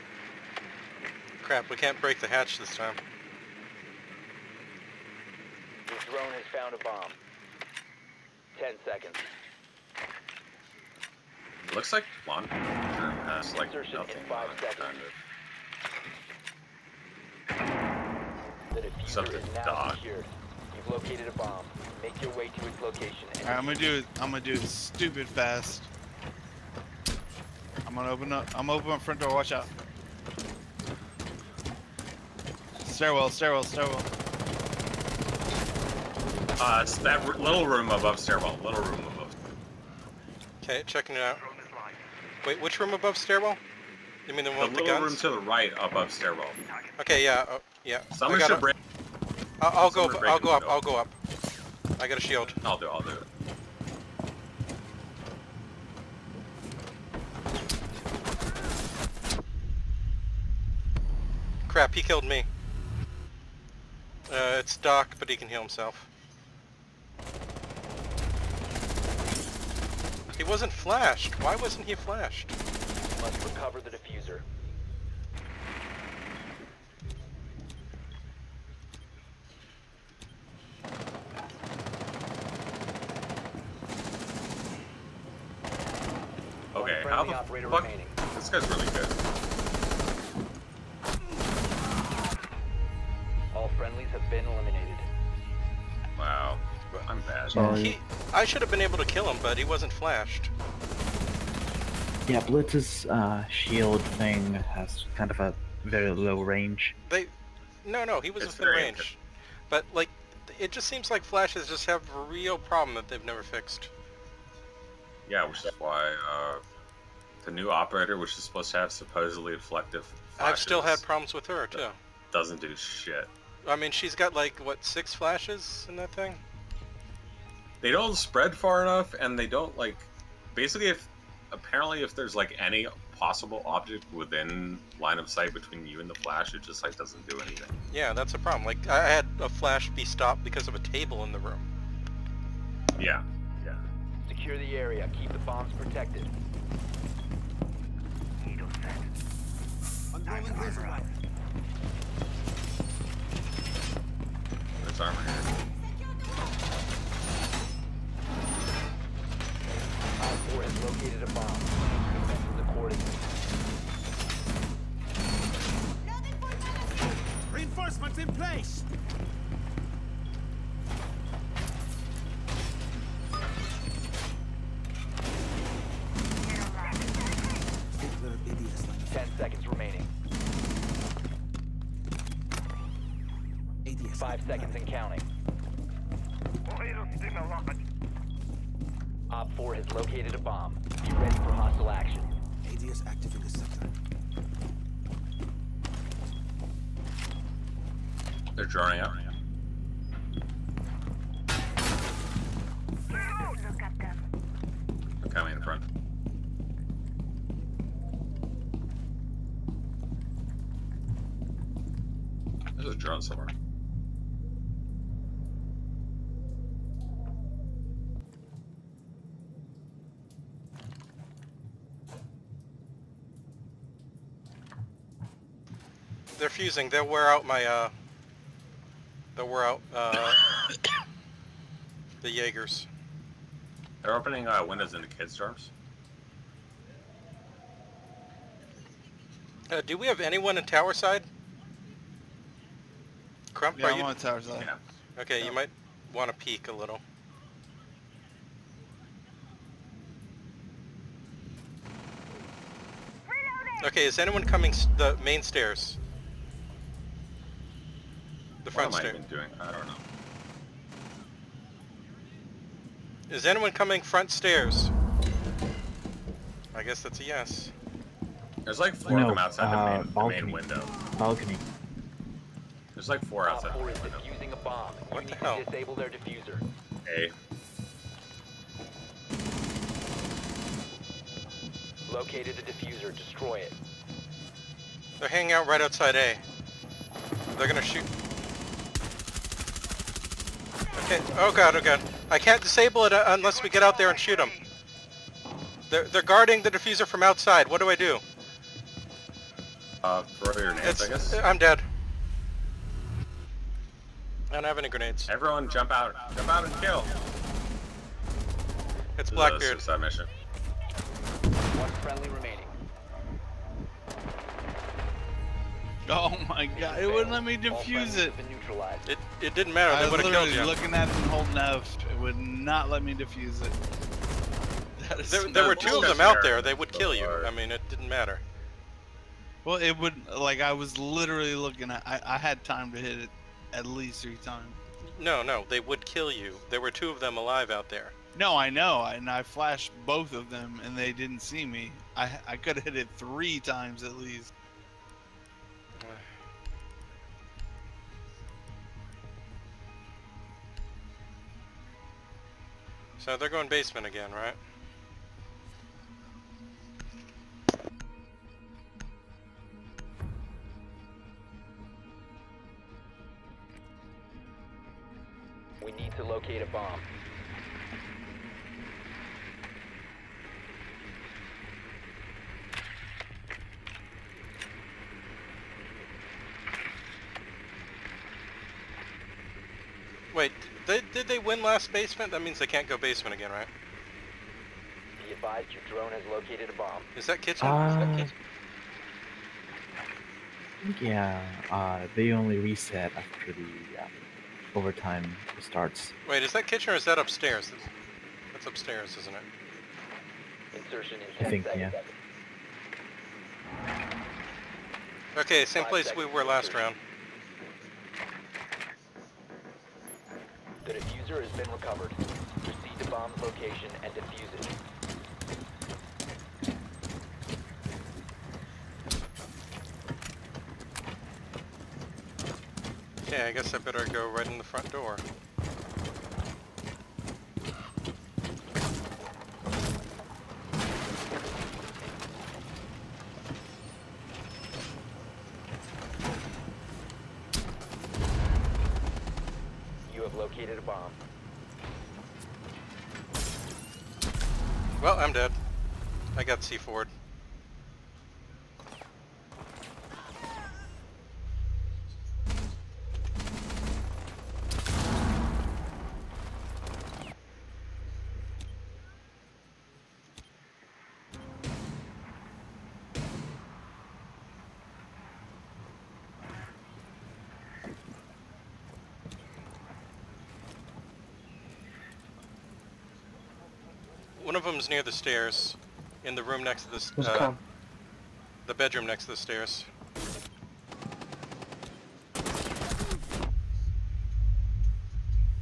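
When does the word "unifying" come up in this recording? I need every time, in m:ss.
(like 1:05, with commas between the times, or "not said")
not said.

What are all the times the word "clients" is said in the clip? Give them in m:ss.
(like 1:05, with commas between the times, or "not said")
not said.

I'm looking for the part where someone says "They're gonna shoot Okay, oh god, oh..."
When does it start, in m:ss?
4:47.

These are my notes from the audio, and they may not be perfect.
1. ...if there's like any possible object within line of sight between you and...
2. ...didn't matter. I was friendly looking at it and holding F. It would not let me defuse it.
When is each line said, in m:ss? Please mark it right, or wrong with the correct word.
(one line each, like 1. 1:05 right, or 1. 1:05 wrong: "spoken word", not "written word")
1. 2:12 right
2. 5:19 wrong: "literally", not "friendly".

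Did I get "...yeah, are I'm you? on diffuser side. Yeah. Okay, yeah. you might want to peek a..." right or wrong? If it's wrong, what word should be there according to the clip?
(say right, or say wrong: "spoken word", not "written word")
wrong: "tower", not "diffuser".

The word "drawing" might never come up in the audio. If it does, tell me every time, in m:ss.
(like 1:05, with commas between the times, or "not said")
3:18.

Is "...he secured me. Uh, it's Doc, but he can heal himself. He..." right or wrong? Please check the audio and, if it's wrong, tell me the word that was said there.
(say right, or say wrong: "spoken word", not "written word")
wrong: "killed", not "secured".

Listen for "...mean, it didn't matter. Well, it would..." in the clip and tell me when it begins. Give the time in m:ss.
5:27.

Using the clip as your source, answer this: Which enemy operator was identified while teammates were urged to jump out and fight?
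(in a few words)
Blackbeard.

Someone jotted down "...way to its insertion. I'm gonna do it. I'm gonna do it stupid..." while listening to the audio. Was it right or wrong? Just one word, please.
wrong.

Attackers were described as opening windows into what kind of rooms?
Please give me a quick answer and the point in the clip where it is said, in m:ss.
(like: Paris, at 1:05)
Kids' dorms, at 3:55.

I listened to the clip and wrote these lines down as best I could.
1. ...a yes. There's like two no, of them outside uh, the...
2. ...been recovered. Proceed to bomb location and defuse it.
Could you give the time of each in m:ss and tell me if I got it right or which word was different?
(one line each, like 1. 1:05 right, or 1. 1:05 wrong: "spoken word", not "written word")
1. 4:27 wrong: "four", not "two"
2. 6:51 right.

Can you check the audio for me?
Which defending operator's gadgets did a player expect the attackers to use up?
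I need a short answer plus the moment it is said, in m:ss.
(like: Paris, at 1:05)
Jaegers, at 3:52.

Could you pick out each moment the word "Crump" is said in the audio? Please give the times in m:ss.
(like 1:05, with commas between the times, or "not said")
4:03.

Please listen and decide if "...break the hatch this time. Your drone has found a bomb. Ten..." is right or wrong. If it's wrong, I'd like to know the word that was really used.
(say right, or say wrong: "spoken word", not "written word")
right.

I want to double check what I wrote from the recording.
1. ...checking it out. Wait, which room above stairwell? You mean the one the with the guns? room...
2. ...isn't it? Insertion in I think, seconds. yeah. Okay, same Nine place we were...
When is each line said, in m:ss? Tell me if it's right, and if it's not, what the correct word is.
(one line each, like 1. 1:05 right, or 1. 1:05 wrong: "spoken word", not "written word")
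1. 0:40 right
2. 6:39 wrong: "Five", not "Nine".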